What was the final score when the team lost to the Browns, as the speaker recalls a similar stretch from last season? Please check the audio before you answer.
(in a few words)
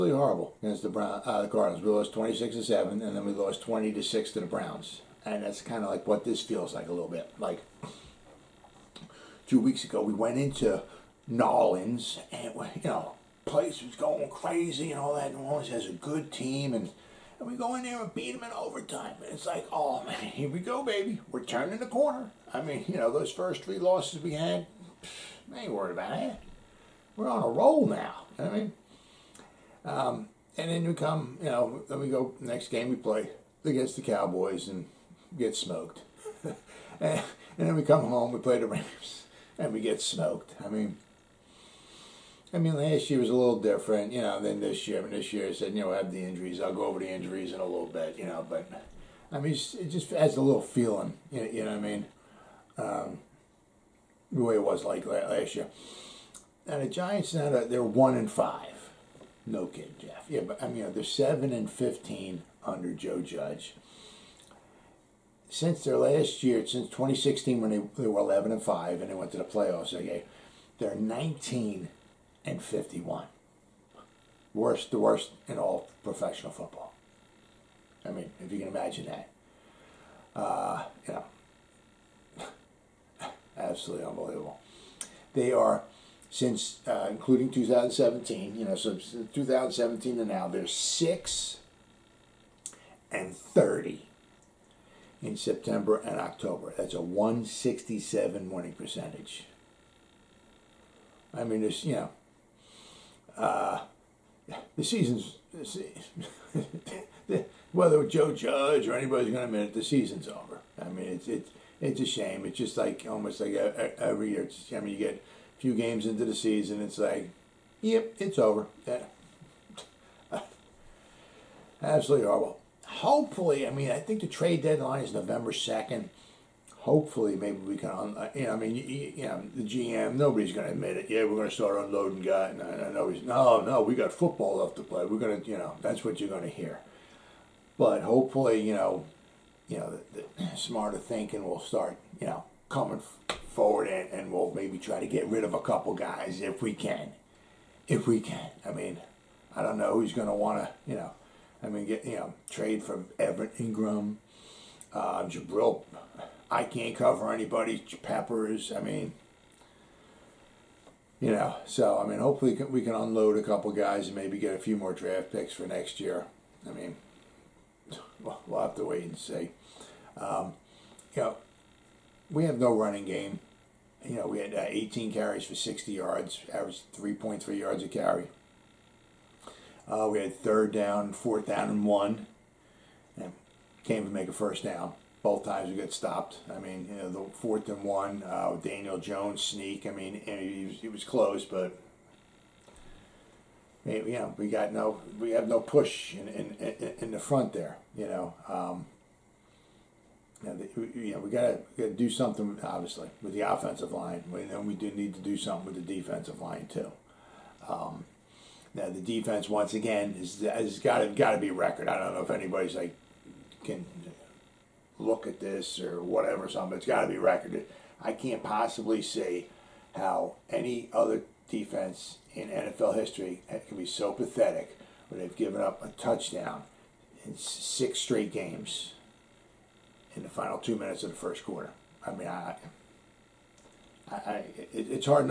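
20 to 6.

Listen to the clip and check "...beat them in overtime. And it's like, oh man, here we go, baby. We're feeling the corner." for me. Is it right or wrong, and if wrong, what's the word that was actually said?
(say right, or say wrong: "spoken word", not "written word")
wrong: "turning", not "feeling".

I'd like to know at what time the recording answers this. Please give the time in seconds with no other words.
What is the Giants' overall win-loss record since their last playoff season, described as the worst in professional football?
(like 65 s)
70 s.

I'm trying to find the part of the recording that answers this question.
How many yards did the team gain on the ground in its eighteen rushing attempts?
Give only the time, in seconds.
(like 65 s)
175 s.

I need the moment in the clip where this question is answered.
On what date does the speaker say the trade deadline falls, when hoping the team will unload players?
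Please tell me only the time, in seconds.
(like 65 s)
125 s.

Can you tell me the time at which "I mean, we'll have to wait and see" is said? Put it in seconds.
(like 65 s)
166 s.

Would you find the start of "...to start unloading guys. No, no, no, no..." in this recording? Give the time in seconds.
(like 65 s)
131 s.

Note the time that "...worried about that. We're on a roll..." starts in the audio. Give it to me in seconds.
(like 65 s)
25 s.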